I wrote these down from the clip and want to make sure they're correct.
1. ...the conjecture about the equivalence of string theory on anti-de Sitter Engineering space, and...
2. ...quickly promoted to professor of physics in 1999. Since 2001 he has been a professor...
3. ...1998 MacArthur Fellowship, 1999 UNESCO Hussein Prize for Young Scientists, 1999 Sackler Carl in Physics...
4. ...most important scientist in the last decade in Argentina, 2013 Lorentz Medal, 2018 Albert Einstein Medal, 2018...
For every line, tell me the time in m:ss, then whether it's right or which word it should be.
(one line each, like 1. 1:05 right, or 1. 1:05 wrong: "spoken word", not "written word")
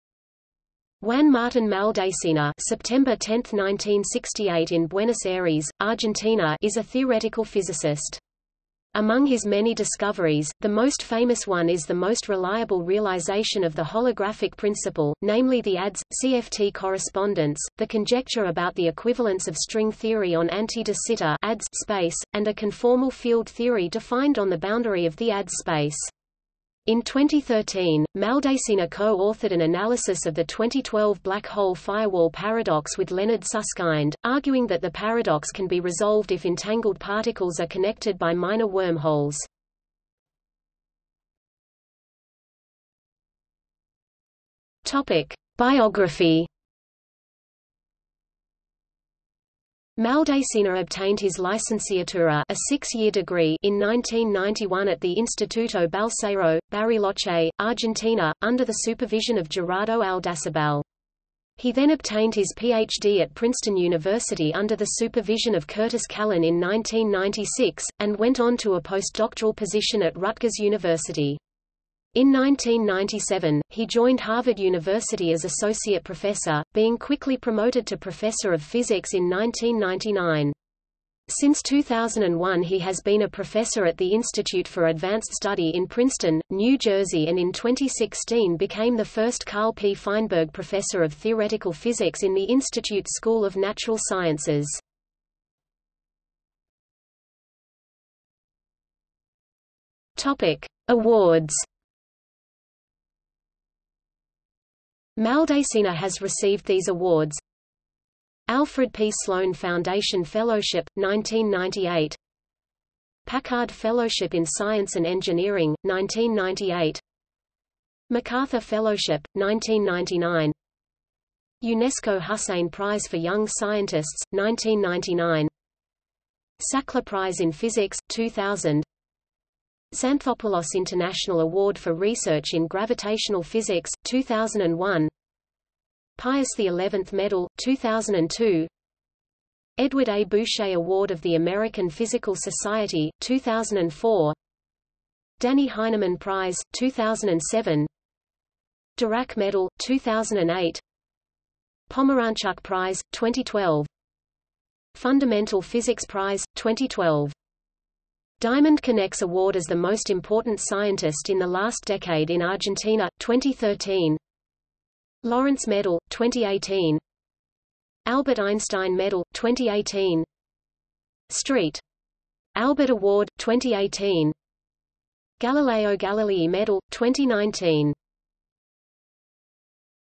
1. 0:17 wrong: "ADS", not "Engineering"
2. 1:16 right
3. 1:55 wrong: "Prize", not "Carl"
4. 2:39 right.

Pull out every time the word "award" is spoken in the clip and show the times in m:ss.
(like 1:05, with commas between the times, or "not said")
1:40, 1:46, 2:11, 2:20, 2:39, 2:52.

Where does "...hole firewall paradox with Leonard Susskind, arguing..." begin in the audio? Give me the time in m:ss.
0:31.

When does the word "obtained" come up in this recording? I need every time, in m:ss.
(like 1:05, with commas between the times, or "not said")
0:50, 1:01.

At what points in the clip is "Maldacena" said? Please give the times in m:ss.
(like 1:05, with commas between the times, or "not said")
0:01, 0:28, 0:50, 1:45.